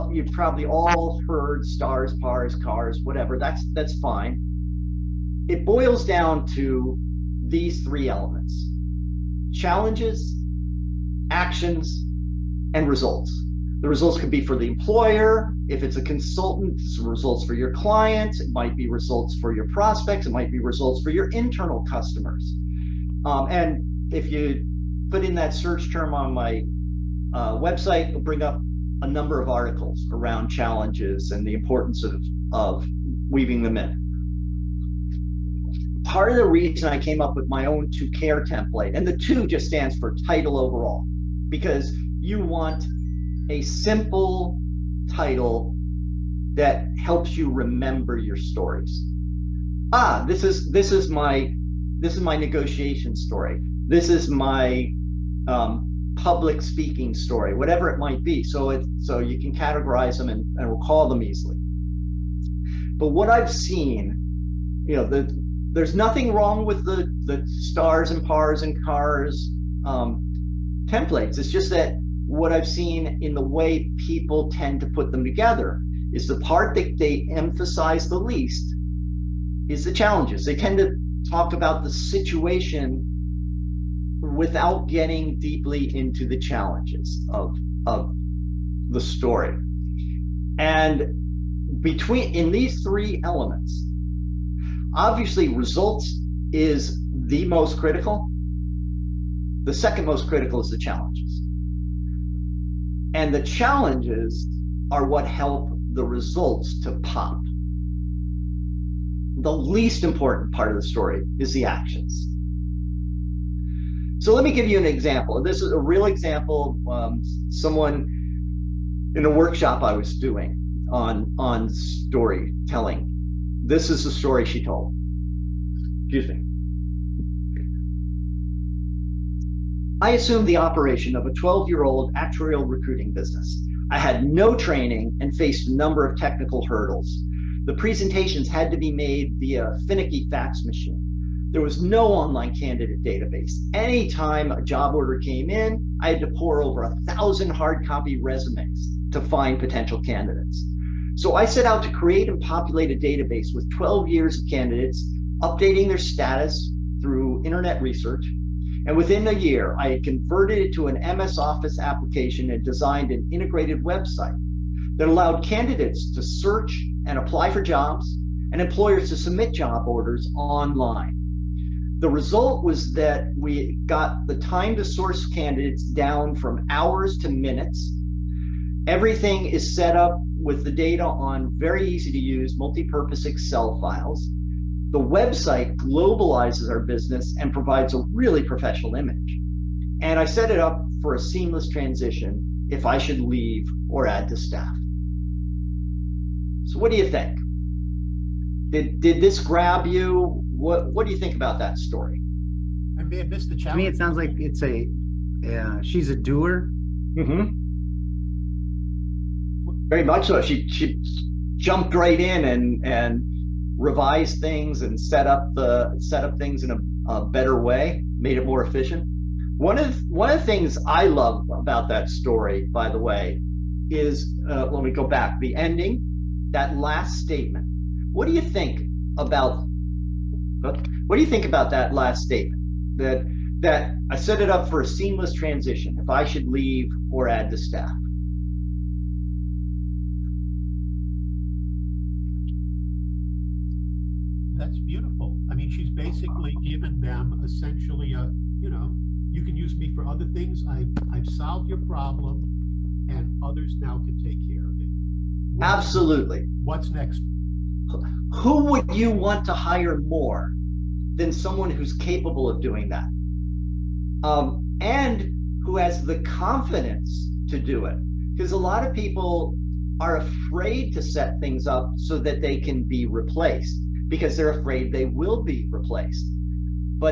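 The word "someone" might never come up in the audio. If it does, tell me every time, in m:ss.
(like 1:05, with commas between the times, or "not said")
1:57, 4:21.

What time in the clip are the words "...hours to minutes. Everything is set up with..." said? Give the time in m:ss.
2:56.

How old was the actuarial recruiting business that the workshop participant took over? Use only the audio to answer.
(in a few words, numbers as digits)
12 years old.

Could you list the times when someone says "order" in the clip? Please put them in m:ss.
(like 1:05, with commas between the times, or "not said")
2:24, 2:49.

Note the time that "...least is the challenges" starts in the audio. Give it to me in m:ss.
1:18.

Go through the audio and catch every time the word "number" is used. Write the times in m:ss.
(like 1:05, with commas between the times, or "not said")
0:29, 2:15.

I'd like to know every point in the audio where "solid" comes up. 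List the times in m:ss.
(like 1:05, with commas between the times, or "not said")
not said.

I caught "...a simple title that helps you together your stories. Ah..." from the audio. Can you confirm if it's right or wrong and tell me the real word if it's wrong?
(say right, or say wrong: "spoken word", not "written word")
wrong: "remember", not "together".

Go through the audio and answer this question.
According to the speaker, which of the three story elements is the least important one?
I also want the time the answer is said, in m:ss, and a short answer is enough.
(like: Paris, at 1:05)
The actions, at 1:49.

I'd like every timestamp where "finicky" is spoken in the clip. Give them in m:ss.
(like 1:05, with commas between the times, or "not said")
2:19.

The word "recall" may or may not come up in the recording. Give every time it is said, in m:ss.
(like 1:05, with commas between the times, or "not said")
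1:00.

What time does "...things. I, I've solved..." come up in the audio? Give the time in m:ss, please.
4:10.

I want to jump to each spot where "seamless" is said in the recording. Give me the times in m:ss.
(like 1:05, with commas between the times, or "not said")
3:11, 3:54.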